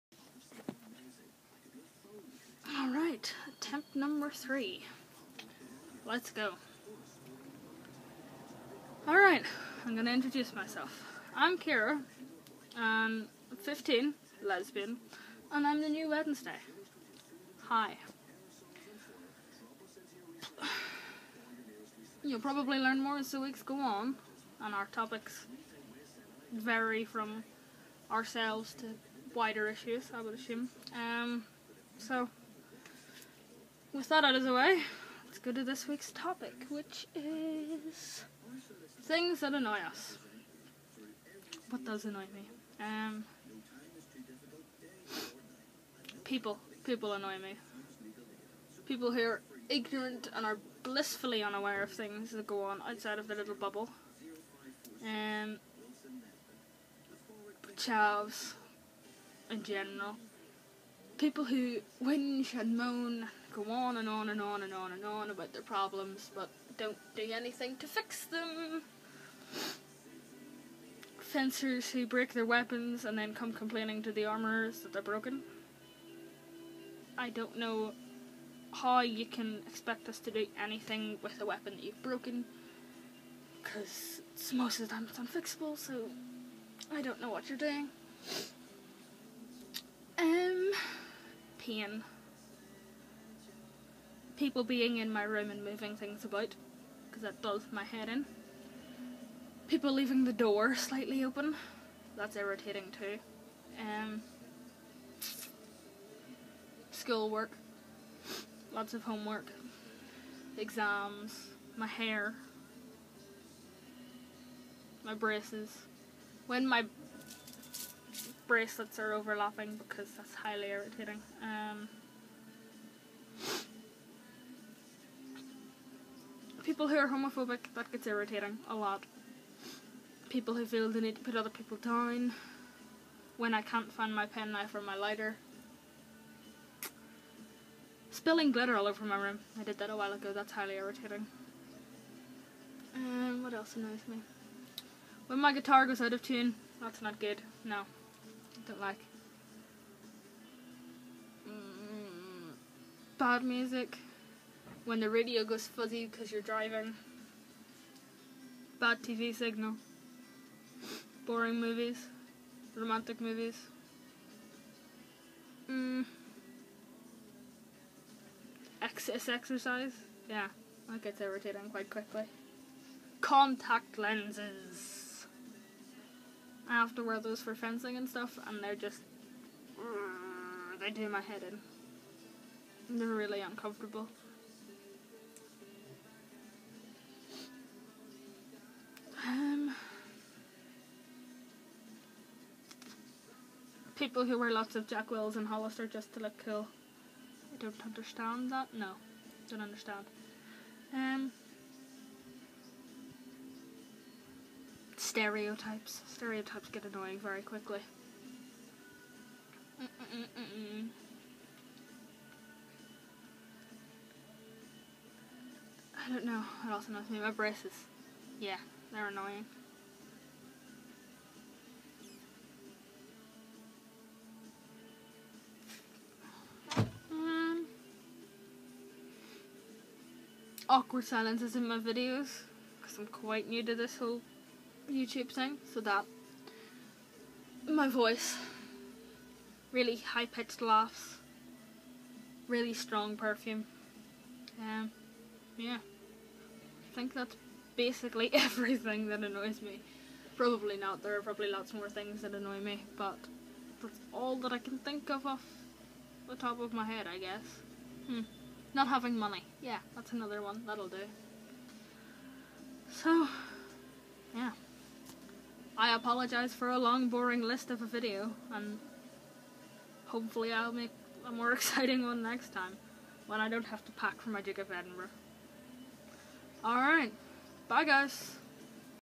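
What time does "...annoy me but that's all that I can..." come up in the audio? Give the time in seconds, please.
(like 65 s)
252 s.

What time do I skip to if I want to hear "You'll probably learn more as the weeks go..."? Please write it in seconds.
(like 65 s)
22 s.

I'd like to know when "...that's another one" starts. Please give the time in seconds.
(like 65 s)
259 s.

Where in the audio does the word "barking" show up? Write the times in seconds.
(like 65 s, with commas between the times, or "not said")
not said.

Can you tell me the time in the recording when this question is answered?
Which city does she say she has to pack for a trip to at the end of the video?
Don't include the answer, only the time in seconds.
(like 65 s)
274 s.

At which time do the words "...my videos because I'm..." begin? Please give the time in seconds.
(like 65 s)
231 s.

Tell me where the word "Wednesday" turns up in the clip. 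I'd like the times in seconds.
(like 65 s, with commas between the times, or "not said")
16 s.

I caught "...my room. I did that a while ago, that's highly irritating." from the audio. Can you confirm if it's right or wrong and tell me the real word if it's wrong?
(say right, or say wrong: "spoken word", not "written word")
right.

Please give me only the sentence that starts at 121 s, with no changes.
Um, people who are homophobic, that gets irritating a lot.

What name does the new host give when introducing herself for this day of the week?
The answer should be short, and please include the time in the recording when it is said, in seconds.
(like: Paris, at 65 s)
Kiara, at 11 s.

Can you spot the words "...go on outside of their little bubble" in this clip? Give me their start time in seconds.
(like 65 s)
52 s.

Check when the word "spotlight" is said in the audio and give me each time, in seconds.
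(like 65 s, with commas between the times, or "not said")
not said.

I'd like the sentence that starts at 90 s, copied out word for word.
Um, pain people being in my room and moving things about because that does my head in.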